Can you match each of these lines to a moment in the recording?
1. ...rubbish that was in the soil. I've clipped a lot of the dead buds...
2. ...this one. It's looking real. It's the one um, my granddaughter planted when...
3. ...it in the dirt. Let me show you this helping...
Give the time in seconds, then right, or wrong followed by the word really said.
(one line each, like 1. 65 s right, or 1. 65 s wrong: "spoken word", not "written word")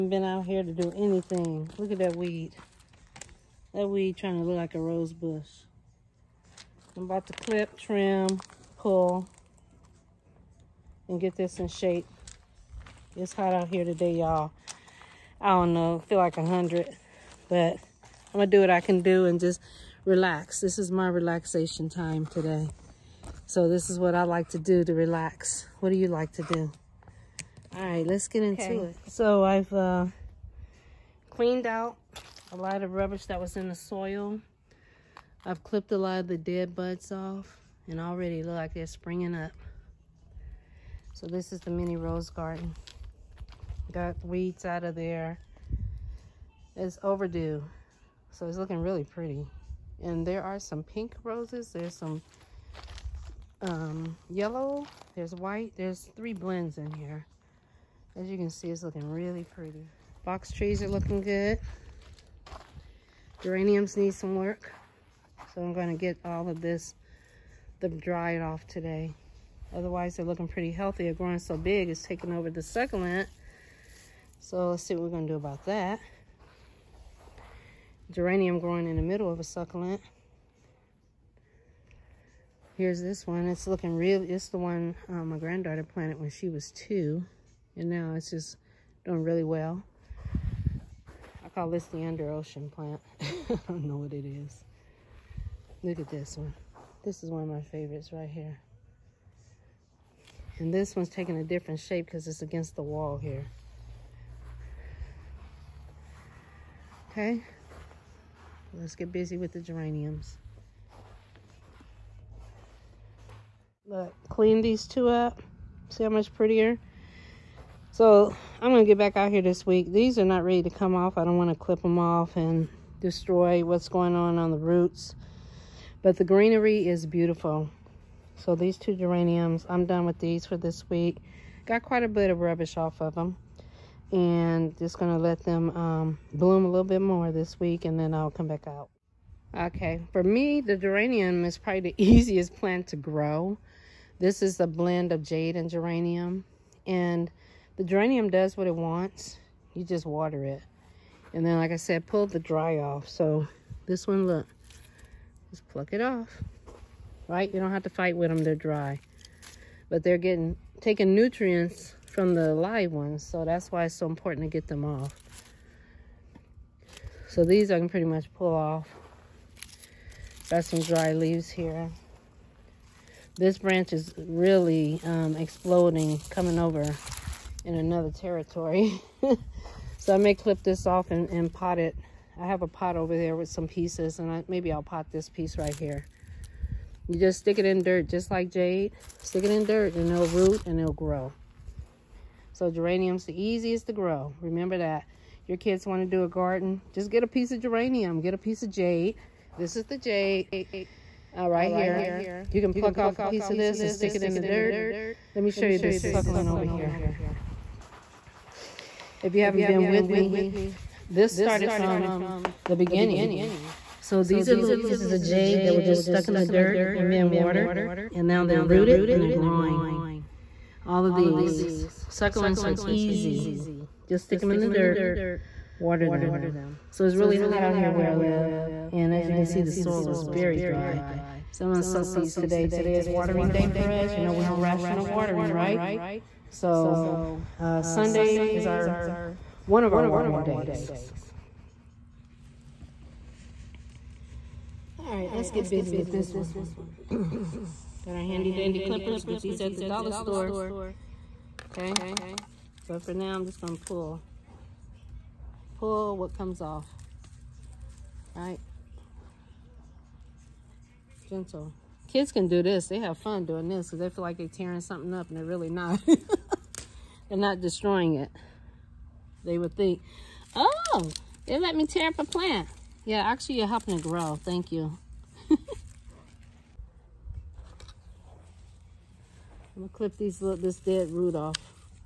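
1. 32 s right
2. 83 s right
3. 204 s wrong: "suckling", not "helping".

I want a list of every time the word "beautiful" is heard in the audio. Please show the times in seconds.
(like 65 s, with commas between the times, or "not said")
127 s.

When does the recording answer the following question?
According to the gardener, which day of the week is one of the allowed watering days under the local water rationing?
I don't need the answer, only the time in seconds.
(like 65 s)
237 s.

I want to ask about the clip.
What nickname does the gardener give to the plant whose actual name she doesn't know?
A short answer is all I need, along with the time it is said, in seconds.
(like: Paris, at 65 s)
under ocean plant, at 92 s.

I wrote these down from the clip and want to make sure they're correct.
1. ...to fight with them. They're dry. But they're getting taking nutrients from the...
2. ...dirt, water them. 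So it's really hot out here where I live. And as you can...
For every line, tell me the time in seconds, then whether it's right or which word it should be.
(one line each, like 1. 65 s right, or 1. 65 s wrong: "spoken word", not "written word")
1. 157 s right
2. 224 s right.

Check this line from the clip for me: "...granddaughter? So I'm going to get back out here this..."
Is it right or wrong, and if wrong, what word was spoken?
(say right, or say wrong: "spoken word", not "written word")
wrong: "prettier", not "granddaughter".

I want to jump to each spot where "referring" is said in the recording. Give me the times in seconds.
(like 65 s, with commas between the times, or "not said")
not said.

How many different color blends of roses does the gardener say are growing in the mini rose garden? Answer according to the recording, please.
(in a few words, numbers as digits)
3.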